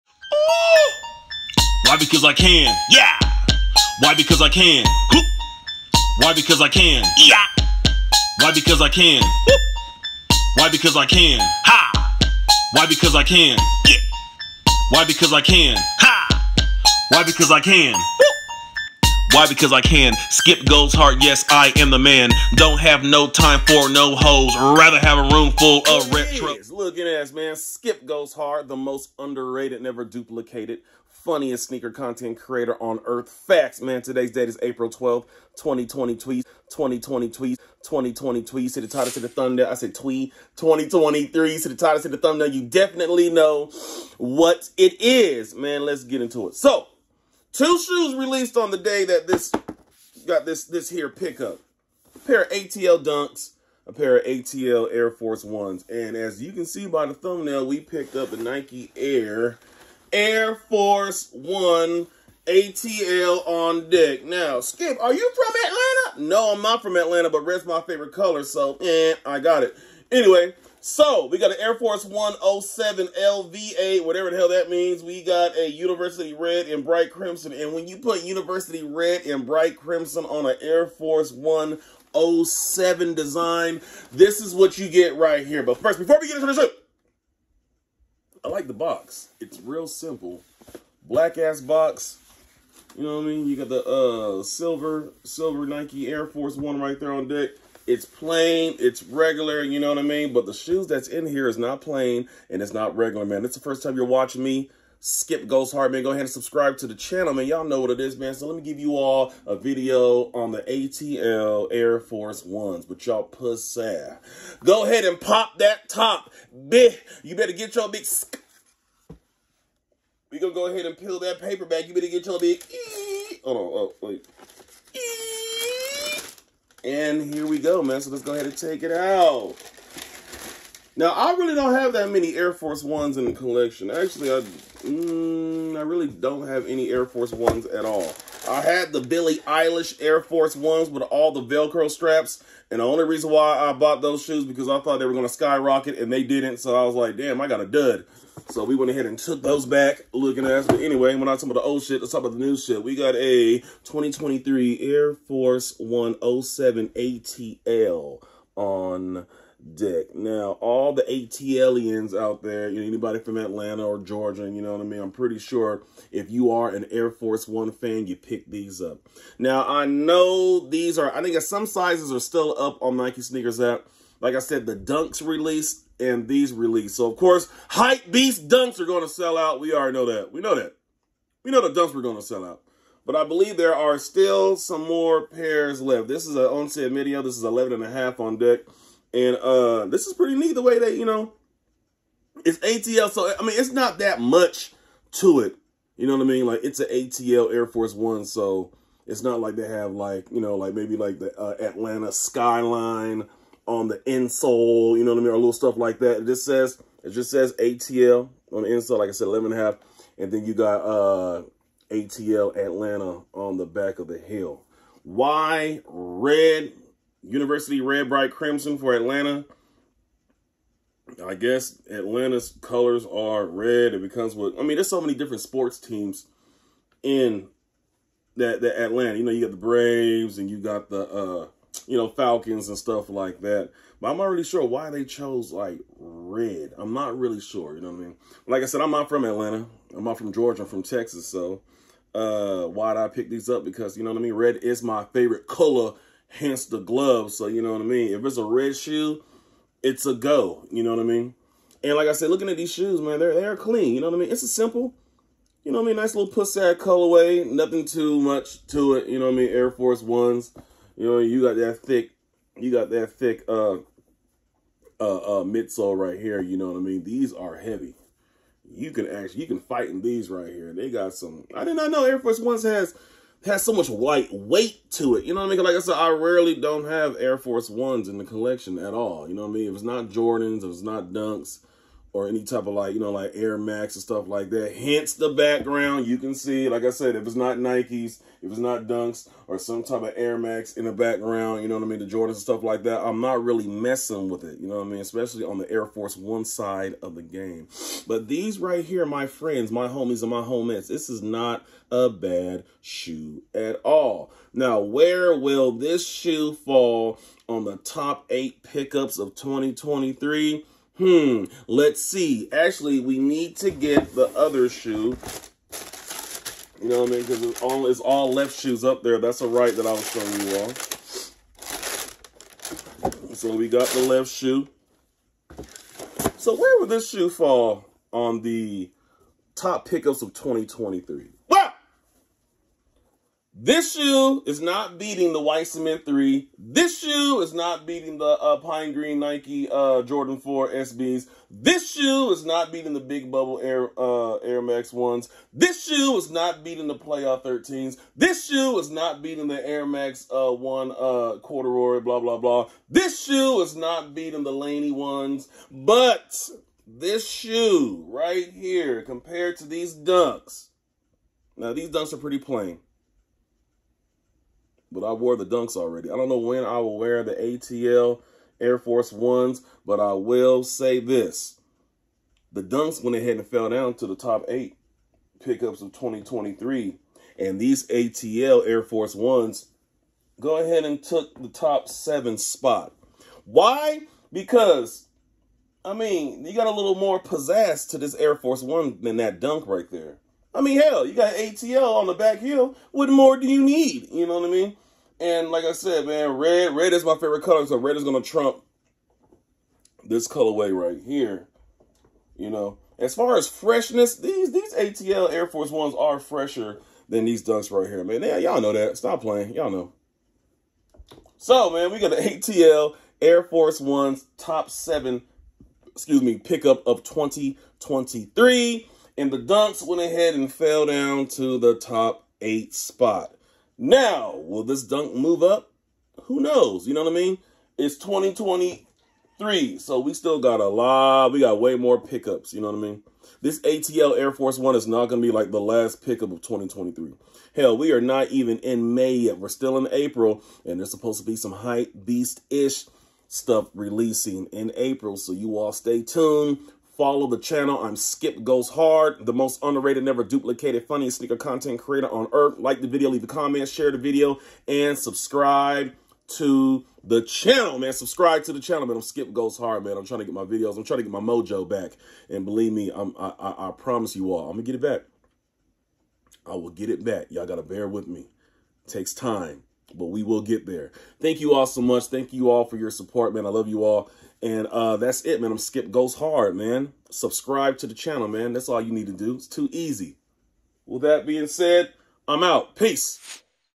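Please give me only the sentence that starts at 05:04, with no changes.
Now, where will this shoe fall on the top eight pickups of 2023?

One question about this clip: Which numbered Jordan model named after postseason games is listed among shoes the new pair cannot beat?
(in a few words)
Playoff 13s.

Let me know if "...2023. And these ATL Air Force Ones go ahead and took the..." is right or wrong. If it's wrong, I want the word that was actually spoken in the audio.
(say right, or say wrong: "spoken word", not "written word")
right.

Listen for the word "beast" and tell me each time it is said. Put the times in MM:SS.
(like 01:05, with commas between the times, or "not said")
02:58, 07:22.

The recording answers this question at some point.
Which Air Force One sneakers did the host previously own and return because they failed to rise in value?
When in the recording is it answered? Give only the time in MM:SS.
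02:18.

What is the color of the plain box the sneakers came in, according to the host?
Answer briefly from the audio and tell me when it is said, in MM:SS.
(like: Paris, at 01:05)
Black, at 01:31.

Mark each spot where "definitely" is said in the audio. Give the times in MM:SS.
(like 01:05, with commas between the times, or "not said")
00:42.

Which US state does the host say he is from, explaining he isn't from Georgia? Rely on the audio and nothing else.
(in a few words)
Texas.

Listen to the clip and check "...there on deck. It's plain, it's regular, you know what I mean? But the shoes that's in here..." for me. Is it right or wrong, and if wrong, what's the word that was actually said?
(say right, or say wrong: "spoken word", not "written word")
right.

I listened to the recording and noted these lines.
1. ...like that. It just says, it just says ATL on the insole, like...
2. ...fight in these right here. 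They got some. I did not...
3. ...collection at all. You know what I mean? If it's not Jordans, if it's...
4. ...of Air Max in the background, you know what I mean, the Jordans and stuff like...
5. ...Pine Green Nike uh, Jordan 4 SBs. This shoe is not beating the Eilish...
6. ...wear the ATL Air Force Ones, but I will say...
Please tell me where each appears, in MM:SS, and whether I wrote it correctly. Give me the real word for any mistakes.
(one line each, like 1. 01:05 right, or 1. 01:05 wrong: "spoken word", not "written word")
1. 03:25 right
2. 04:29 right
3. 04:38 right
4. 04:50 right
5. 05:38 wrong: "Big", not "Eilish"
6. 06:06 right.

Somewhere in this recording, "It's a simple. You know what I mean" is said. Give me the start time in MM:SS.
04:14.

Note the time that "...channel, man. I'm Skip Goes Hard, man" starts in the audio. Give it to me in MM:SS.
07:38.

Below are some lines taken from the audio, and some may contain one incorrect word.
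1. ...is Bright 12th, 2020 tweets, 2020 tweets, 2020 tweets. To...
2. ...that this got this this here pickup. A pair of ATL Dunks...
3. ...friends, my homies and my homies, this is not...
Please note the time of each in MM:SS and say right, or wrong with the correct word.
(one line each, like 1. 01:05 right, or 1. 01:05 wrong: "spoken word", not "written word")
1. 00:34 wrong: "April", not "Bright"
2. 00:49 right
3. 04:59 right.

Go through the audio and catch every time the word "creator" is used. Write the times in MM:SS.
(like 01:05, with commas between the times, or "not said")
00:32, 07:31.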